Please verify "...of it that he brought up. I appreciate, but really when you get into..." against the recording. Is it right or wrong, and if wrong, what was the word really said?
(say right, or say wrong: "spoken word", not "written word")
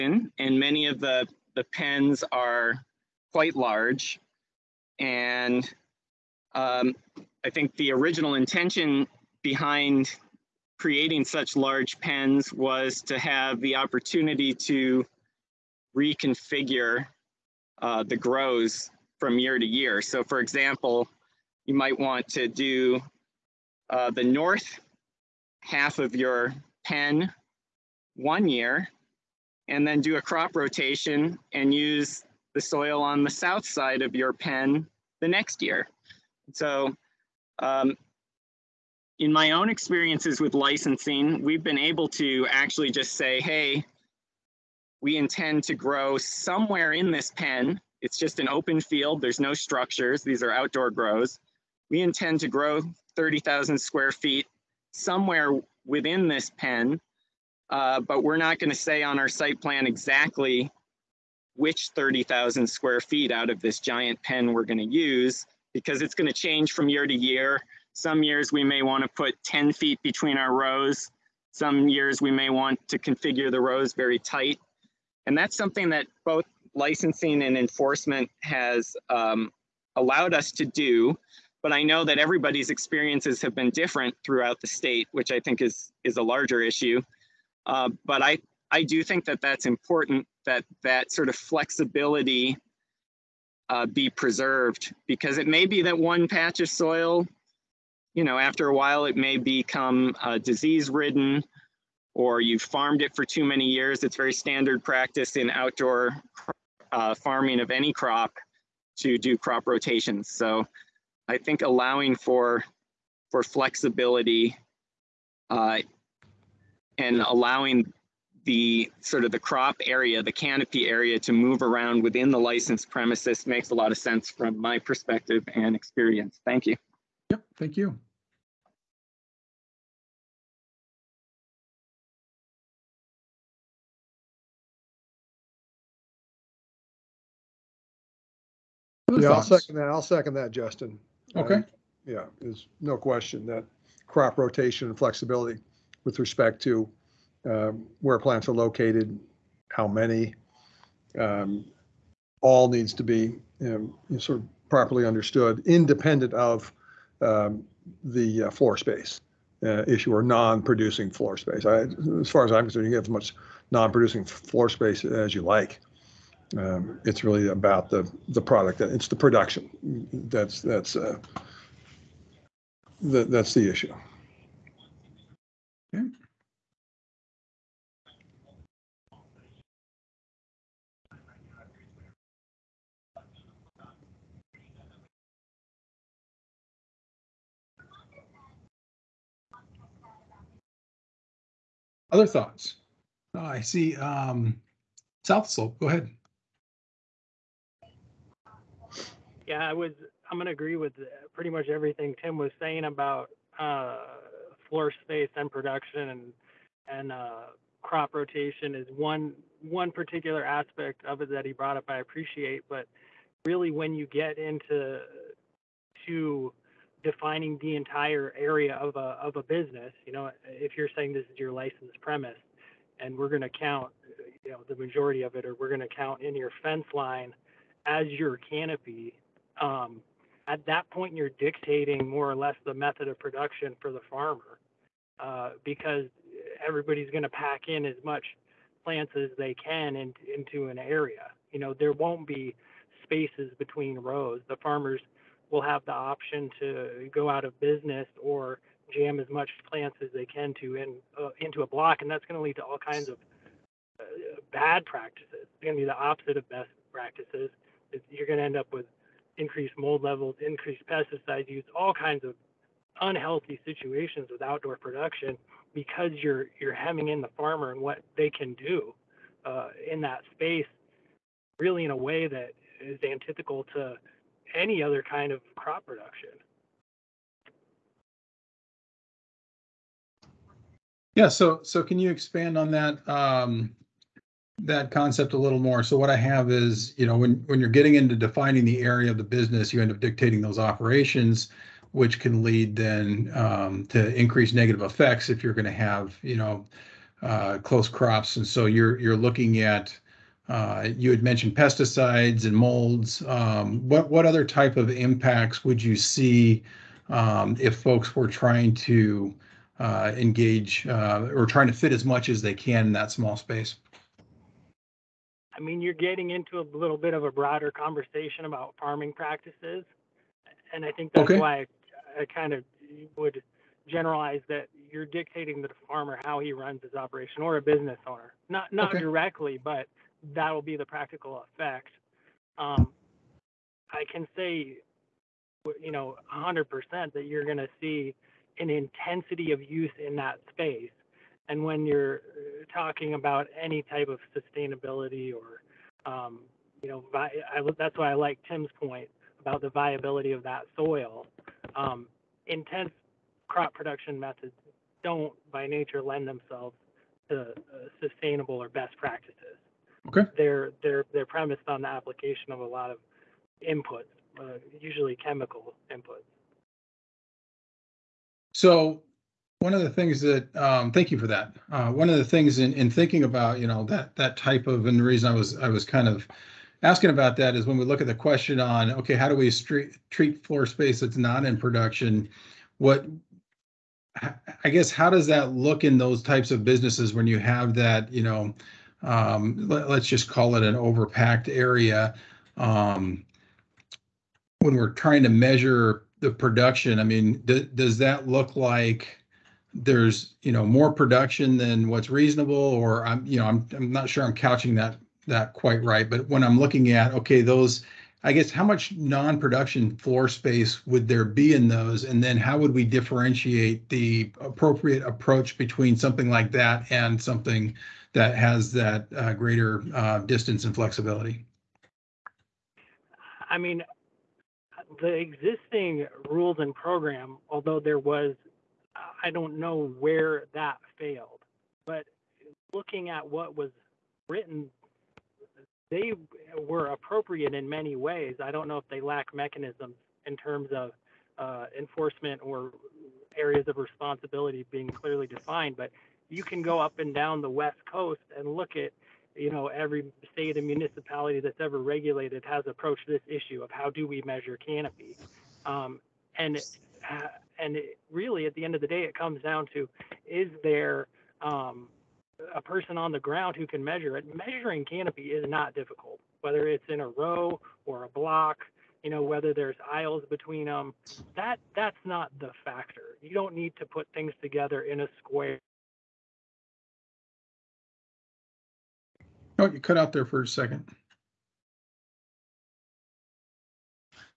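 right.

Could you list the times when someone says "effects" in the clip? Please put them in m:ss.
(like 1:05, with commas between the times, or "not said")
4:54, 5:31.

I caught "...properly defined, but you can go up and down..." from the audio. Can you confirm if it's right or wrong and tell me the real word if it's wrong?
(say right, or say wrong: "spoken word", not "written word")
wrong: "clearly", not "properly".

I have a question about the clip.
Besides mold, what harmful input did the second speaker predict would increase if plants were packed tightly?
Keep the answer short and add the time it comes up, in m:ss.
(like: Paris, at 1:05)
pesticide use, at 4:20.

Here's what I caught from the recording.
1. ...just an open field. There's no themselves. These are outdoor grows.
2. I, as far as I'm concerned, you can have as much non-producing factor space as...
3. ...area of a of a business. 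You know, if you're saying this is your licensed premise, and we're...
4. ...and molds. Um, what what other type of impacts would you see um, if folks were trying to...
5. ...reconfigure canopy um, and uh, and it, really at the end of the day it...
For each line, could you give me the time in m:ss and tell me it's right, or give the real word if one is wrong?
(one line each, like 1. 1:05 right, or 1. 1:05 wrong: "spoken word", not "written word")
1. 0:48 wrong: "structures", not "themselves"
2. 2:41 wrong: "floor", not "factor"
3. 3:38 right
4. 5:02 right
5. 7:34 wrong: "measure", not "reconfigure".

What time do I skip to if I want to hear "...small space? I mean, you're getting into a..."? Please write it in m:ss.
5:13.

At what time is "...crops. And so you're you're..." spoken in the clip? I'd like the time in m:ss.
4:57.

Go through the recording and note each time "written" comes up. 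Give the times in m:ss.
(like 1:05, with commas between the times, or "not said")
7:14.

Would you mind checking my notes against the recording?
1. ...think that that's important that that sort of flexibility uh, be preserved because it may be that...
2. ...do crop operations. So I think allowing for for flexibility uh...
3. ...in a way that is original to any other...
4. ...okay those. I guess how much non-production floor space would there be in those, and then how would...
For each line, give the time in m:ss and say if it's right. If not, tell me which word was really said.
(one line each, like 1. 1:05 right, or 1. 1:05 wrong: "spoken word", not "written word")
1. 1:29 right
2. 1:49 wrong: "rotations", not "operations"
3. 4:31 wrong: "antithetical", not "original"
4. 6:47 right.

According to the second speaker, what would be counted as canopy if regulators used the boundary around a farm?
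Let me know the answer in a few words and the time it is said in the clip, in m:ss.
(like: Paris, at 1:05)
fence line, at 3:46.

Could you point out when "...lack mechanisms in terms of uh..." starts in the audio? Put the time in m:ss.
7:19.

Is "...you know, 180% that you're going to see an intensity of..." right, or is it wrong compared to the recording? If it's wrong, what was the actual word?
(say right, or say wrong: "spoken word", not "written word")
wrong: "100", not "180".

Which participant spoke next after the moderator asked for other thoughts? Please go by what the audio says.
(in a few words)
South Slope.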